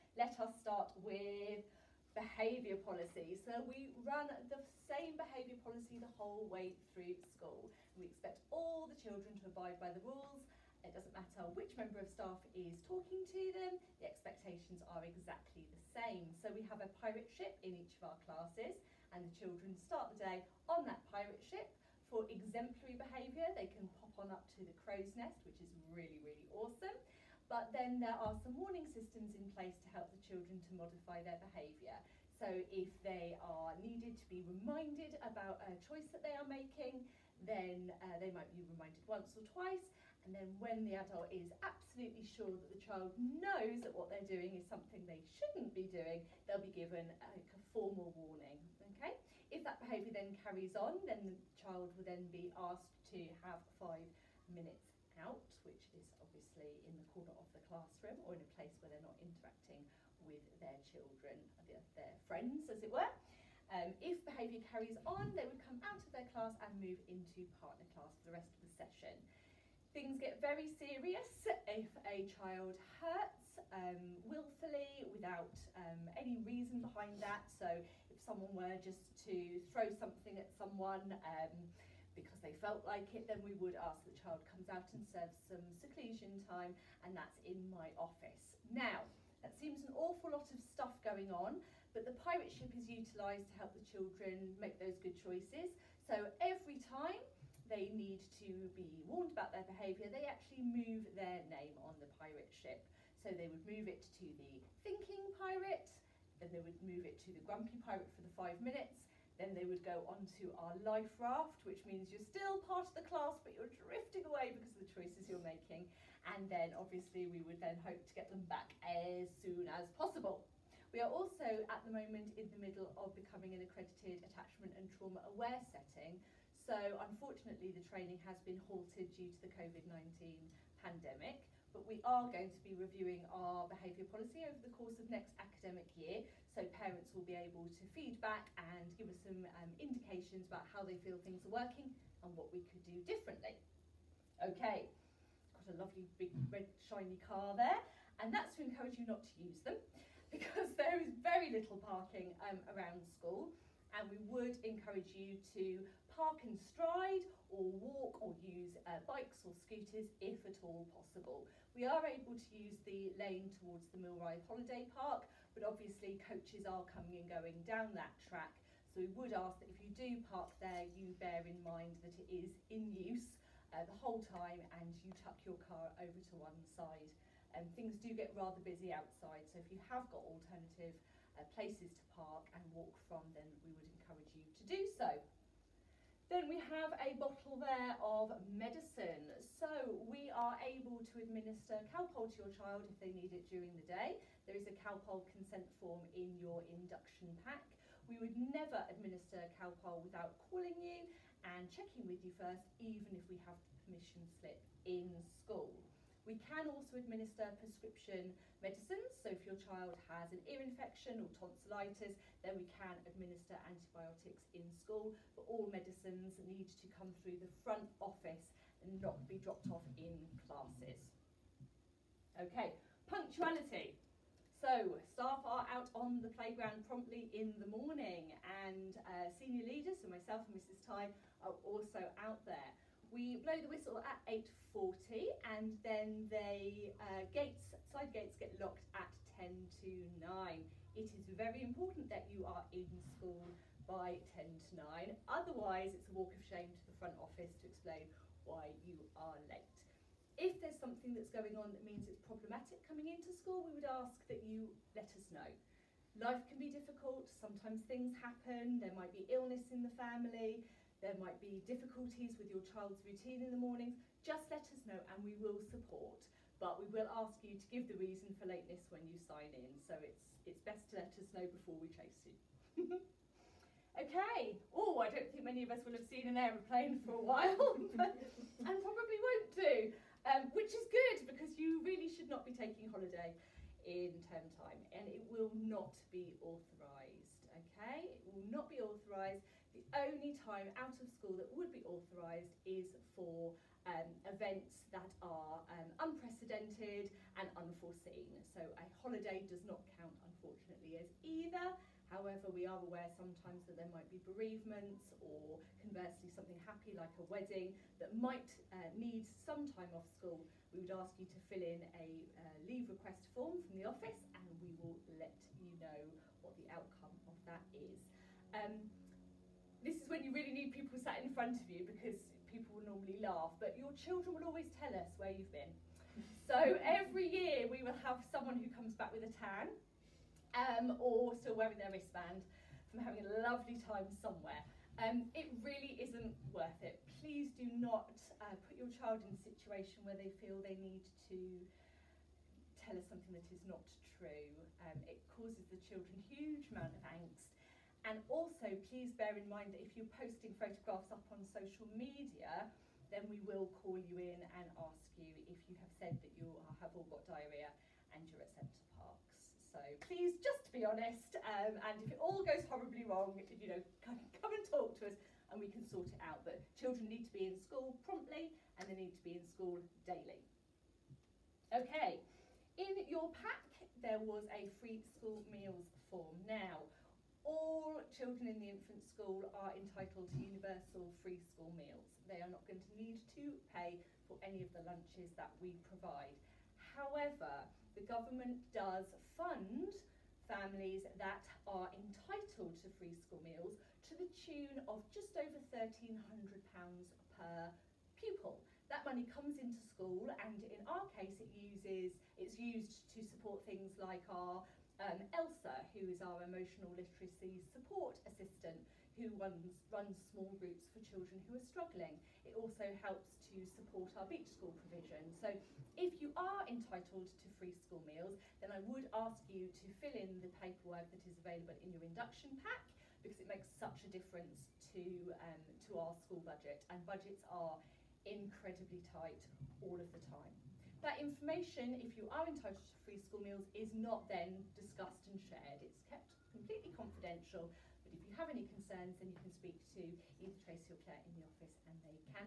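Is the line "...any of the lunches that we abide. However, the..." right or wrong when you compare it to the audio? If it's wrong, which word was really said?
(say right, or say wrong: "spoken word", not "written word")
wrong: "provide", not "abide".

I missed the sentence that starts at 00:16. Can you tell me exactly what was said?
So we have a pirate ship in each of our classes and the children start the day on that pirate ship.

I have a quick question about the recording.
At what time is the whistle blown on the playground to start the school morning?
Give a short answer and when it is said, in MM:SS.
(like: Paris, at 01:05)
8:40, at 03:54.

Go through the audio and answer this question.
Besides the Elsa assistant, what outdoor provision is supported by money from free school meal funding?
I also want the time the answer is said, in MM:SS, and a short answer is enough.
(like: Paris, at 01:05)
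beach school, at 06:54.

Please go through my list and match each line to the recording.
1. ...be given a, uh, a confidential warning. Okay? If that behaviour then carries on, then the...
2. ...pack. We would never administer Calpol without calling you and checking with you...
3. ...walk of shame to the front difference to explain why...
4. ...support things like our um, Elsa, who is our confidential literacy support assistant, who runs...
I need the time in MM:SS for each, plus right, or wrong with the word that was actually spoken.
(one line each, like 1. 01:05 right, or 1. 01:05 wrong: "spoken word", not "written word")
1. 00:46 wrong: "formal", not "confidential"
2. 03:17 right
3. 04:06 wrong: "office", not "difference"
4. 06:43 wrong: "emotional", not "confidential".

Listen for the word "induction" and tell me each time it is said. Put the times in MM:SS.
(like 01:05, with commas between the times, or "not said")
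03:16, 07:02.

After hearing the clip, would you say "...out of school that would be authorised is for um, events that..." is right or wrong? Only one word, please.
right.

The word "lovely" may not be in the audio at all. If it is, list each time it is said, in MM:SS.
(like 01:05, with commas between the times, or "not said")
02:25, 05:33.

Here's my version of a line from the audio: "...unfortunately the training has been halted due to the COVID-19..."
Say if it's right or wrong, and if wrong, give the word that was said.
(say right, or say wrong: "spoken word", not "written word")
right.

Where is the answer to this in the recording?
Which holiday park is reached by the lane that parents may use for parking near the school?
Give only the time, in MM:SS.
02:44.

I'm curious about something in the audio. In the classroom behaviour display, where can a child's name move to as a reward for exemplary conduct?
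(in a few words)
crow's nest.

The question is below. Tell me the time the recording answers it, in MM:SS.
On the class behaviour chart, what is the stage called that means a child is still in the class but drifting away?
01:50.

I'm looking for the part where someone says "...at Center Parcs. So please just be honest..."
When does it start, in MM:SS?
05:58.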